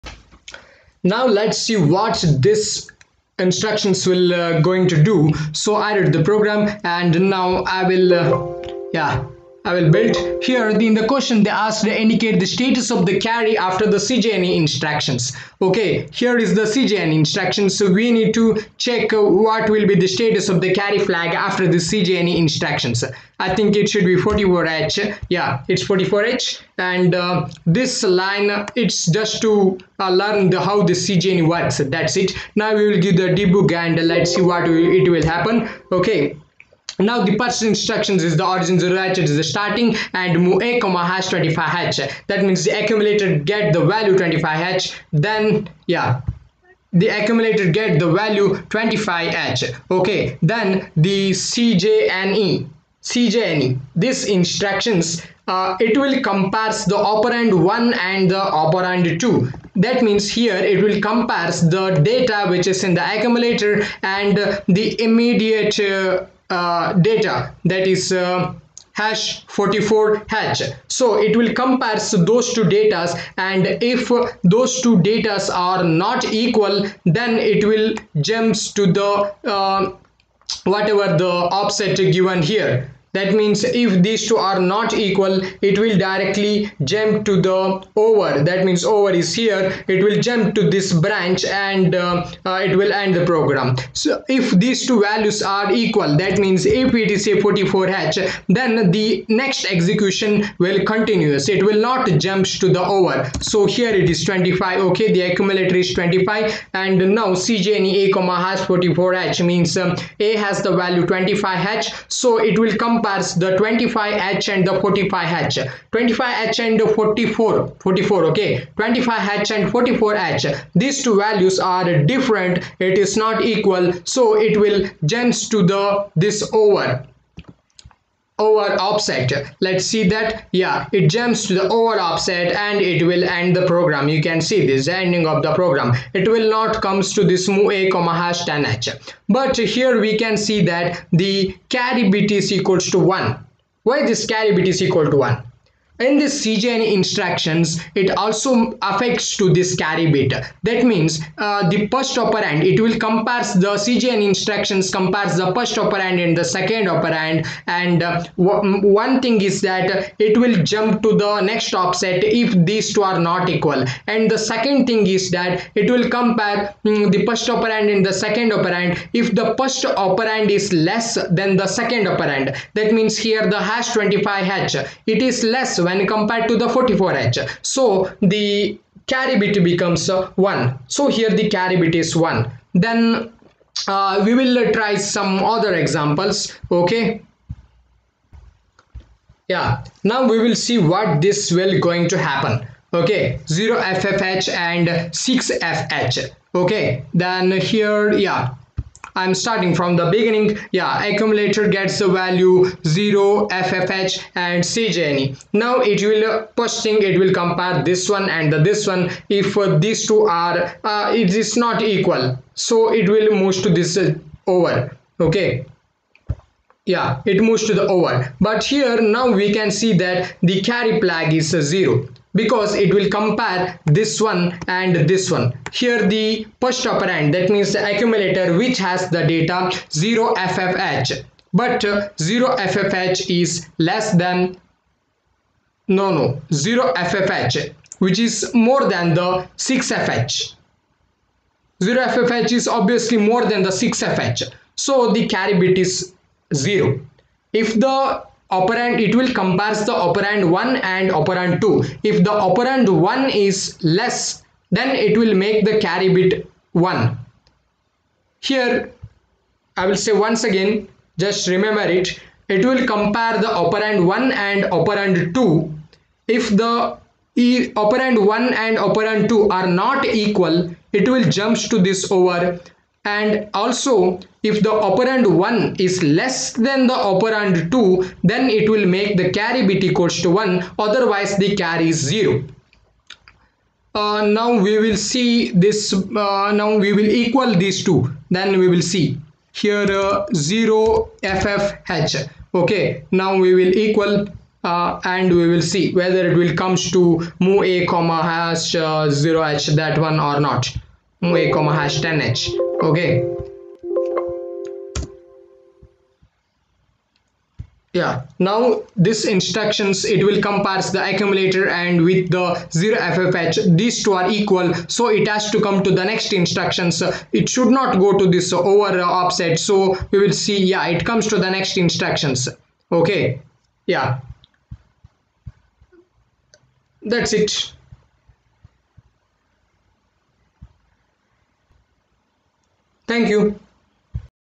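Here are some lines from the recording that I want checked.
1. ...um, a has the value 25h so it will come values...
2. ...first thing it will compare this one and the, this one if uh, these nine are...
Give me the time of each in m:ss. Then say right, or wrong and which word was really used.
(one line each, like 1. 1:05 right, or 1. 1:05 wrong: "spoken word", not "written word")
1. 1:49 wrong: "compares", not "values"
2. 3:26 wrong: "two", not "nine".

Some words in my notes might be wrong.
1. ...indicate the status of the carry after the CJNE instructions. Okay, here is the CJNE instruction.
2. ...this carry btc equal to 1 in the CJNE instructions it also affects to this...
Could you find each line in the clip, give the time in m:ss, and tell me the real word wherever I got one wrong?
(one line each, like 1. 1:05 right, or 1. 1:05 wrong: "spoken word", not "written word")
1. 0:12 right
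2. 2:24 right.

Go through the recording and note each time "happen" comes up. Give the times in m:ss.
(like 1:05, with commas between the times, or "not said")
0:35, 3:12.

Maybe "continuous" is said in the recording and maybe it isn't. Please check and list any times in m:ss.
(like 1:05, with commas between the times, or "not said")
1:40.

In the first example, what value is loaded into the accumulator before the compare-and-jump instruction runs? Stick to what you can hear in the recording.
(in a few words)
25H.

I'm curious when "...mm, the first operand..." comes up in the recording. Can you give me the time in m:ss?
2:46.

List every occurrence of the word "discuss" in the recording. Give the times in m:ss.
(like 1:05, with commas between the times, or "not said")
not said.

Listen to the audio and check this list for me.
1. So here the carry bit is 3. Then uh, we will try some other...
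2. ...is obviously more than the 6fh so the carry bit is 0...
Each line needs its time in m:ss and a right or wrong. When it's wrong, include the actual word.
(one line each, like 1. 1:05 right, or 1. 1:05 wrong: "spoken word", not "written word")
1. 3:00 wrong: "1", not "3"
2. 4:02 right.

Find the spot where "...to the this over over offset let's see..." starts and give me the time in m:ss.
2:05.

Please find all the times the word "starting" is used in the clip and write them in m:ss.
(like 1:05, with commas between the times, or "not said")
0:39, 3:19.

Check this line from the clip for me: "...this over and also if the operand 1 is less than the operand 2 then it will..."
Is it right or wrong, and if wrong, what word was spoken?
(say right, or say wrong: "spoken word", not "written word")
right.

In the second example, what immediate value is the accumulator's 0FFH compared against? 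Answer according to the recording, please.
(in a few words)
6FH.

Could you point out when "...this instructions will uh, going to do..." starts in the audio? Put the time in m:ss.
0:02.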